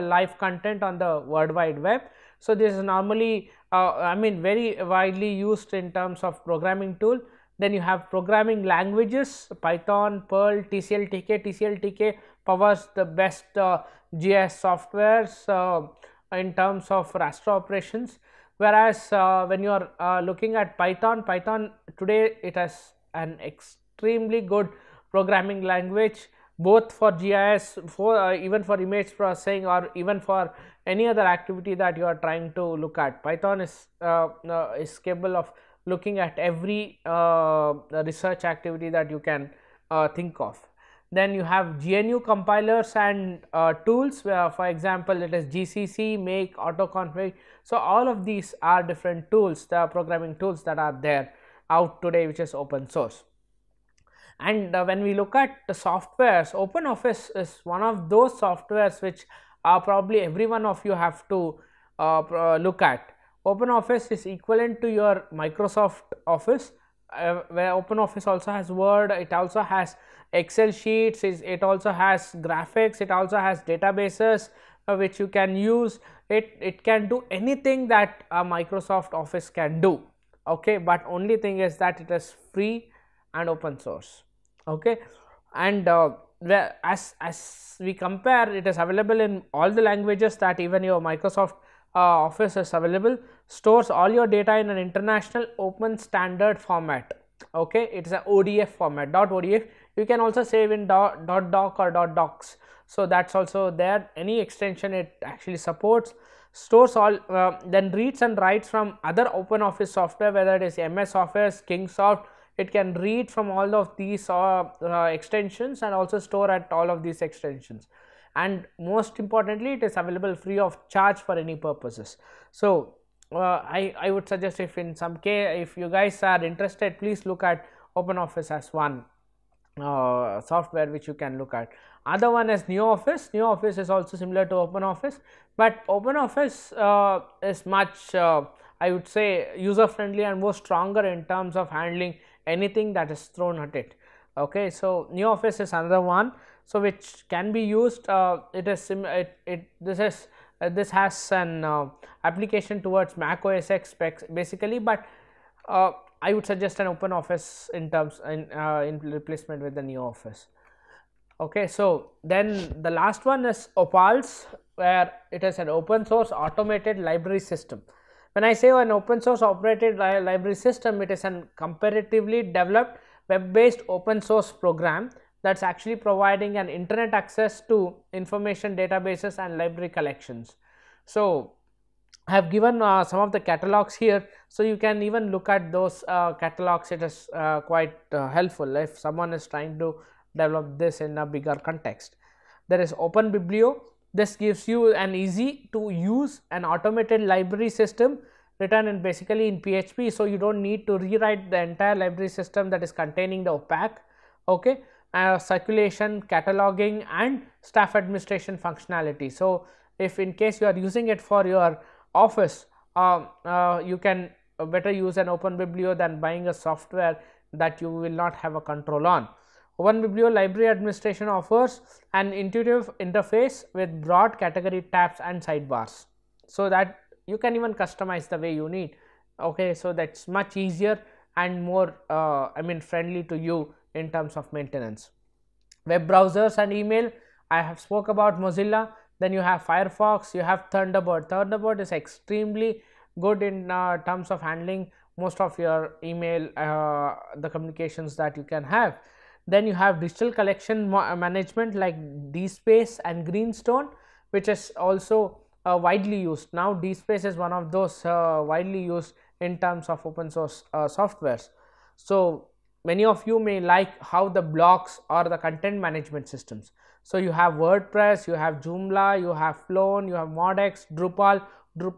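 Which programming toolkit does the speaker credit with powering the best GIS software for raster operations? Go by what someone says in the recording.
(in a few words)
TCL-TK.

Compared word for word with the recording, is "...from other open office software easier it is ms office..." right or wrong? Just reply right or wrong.
wrong.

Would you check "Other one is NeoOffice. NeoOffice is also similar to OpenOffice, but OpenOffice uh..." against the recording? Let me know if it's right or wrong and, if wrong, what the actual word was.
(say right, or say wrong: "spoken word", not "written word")
right.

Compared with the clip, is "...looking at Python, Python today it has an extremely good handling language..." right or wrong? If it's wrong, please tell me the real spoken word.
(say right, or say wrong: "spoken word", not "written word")
wrong: "programming", not "handling".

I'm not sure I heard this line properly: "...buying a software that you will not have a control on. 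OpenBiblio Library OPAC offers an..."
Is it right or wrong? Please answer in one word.
wrong.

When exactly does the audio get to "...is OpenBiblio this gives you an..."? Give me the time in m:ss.
3:12.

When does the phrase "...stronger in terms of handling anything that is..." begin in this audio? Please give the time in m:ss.
2:20.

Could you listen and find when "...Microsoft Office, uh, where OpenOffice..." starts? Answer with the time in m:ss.
1:05.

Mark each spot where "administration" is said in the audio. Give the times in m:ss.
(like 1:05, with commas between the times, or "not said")
3:27, 3:40.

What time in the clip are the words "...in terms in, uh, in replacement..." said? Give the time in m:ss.
2:37.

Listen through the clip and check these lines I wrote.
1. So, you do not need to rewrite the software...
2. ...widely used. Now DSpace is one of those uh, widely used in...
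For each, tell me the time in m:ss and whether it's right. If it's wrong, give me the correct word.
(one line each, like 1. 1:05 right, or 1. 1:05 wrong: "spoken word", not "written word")
1. 3:20 wrong: "entire", not "software"
2. 4:15 right.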